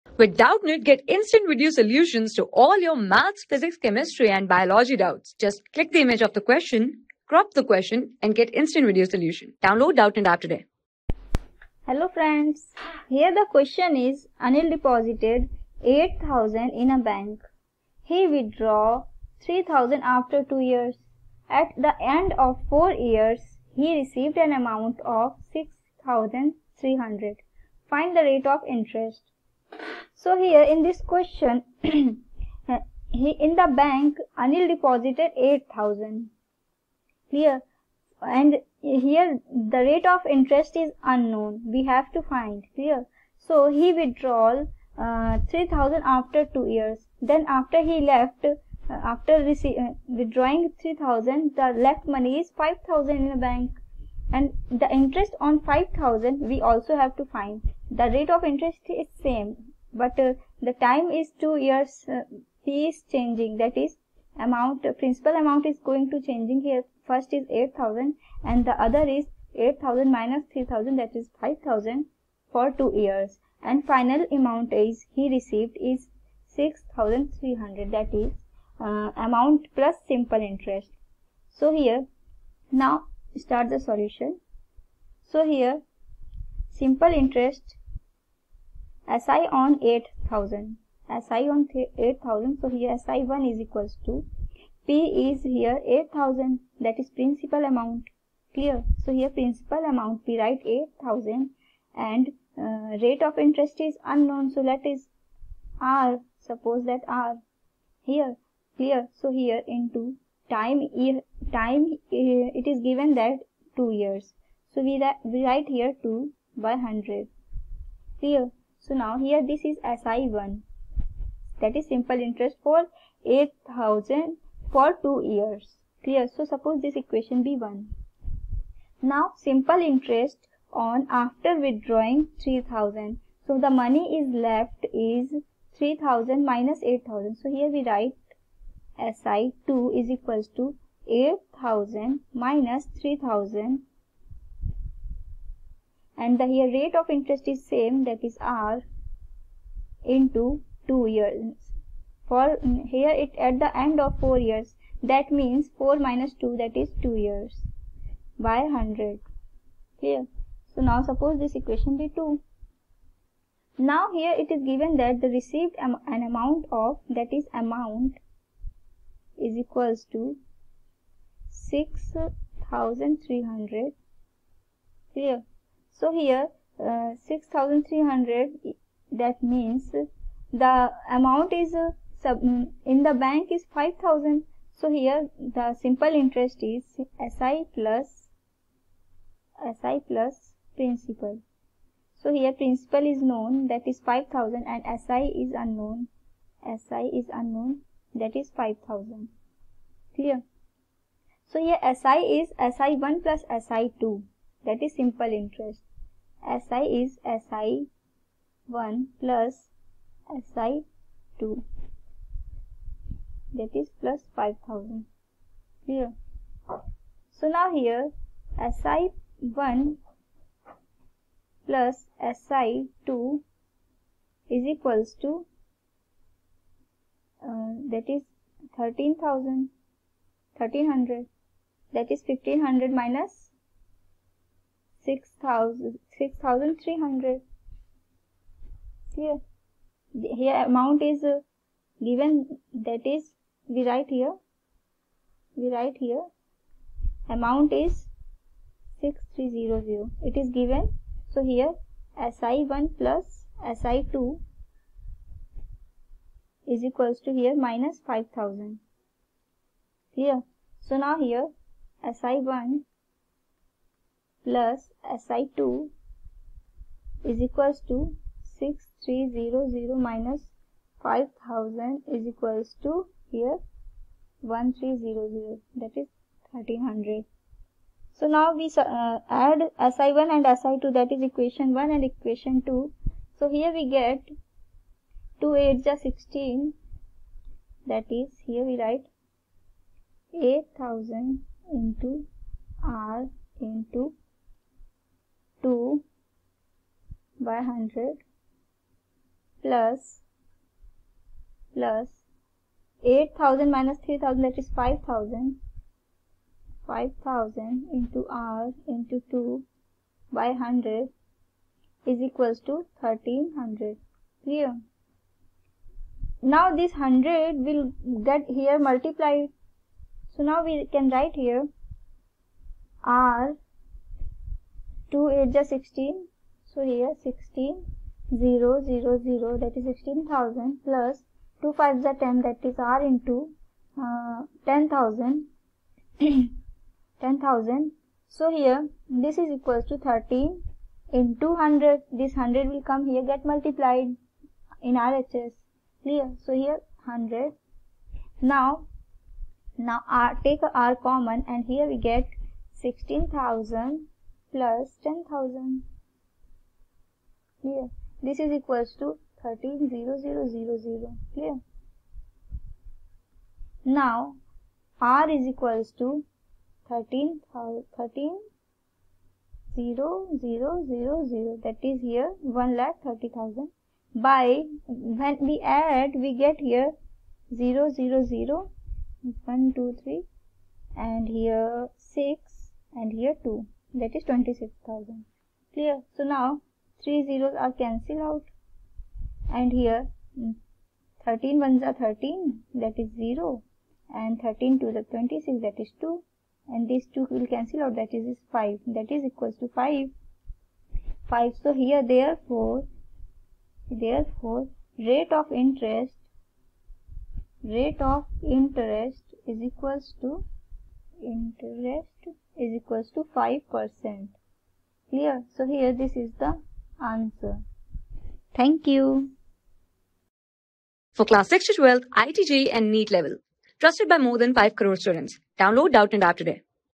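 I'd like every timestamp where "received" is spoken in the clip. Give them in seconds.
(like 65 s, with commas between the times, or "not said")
23 s, 75 s, 165 s.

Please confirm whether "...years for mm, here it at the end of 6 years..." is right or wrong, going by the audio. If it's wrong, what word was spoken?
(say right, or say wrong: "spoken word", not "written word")
wrong: "4", not "6".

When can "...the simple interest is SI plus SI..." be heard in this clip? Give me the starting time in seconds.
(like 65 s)
185 s.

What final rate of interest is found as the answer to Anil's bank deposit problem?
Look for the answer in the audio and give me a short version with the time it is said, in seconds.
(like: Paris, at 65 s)
5 percent, at 413 s.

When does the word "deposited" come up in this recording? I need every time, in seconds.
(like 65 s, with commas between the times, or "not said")
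14 s, 34 s.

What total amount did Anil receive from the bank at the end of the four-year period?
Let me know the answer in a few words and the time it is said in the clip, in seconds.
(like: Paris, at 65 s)
6300, at 23 s.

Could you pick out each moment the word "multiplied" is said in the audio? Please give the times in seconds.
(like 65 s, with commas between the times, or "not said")
318 s, 343 s.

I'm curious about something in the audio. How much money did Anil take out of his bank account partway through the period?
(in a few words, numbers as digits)
3000.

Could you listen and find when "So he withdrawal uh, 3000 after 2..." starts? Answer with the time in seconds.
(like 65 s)
43 s.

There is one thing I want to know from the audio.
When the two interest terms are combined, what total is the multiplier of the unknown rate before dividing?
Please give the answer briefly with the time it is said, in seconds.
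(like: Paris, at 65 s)
26,000, at 384 s.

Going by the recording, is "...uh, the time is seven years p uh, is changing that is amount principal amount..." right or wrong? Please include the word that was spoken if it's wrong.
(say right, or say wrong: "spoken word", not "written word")
wrong: "two", not "seven".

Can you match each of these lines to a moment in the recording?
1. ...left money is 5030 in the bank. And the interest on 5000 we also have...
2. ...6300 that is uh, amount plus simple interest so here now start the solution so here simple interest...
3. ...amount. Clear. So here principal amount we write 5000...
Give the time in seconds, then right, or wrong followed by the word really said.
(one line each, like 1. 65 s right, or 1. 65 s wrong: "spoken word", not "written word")
1. 51 s wrong: "5000", not "5030"
2. 76 s right
3. 97 s wrong: "8000", not "5000".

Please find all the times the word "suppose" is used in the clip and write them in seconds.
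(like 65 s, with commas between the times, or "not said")
106 s, 126 s, 161 s.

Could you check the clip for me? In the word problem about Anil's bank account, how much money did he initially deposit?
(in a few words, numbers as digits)
8000.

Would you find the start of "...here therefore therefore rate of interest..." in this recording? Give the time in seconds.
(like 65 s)
401 s.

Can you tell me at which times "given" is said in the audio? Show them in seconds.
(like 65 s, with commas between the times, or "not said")
112 s, 164 s, 242 s, 250 s.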